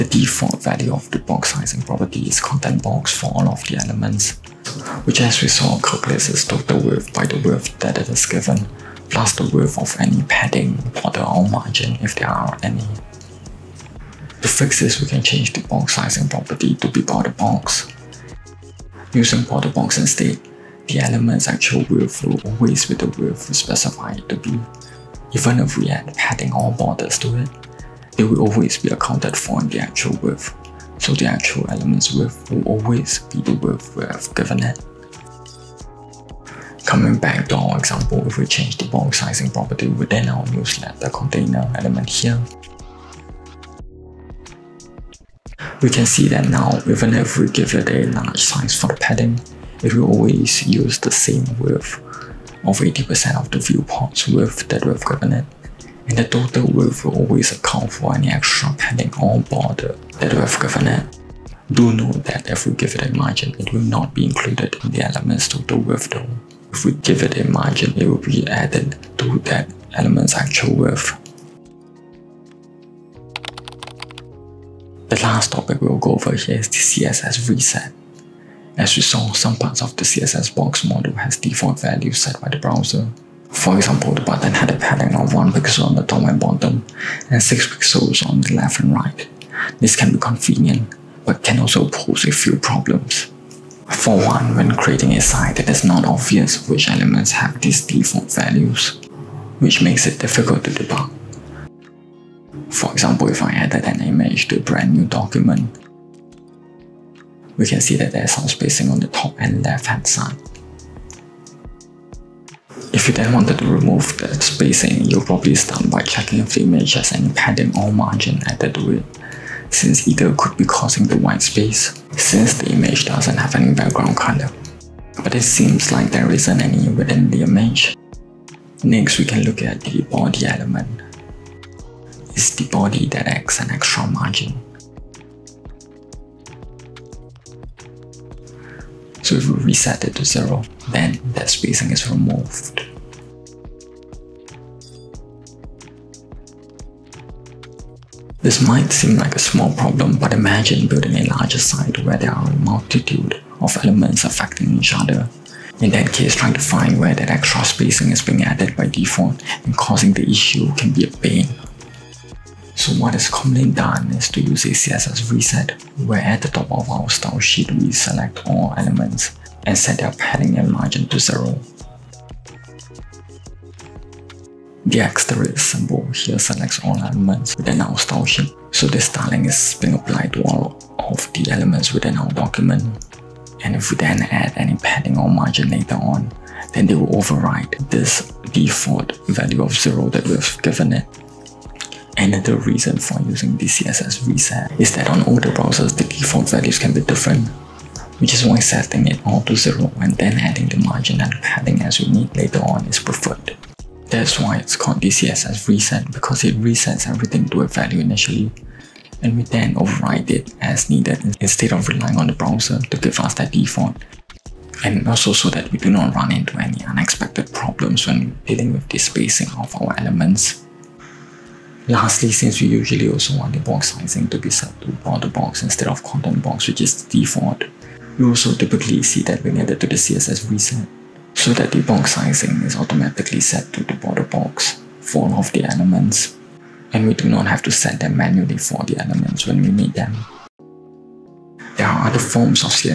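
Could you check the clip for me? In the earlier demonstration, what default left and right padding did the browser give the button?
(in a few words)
6 pixels.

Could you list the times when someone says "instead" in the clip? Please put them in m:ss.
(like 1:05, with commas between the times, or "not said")
0:19, 3:31, 3:45.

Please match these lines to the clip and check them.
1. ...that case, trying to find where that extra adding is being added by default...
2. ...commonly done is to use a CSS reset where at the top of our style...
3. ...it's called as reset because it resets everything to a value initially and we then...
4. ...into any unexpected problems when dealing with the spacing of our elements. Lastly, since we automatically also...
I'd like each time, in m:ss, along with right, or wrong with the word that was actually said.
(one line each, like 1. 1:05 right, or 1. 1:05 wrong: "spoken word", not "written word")
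1. 2:35 wrong: "spacing", not "adding"
2. 2:43 right
3. 3:24 right
4. 3:36 wrong: "usually", not "automatically".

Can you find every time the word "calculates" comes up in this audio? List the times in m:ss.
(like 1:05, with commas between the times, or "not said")
0:05.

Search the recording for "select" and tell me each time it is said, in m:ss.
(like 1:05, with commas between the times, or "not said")
2:47, 2:56.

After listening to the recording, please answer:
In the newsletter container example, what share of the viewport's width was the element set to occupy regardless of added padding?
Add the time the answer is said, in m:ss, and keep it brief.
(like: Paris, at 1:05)
80%, at 0:52.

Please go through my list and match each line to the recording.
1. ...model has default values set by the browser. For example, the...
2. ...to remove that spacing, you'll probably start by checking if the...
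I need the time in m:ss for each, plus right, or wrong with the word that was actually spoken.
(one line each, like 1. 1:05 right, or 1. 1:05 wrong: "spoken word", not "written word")
1. 1:20 right
2. 1:53 right.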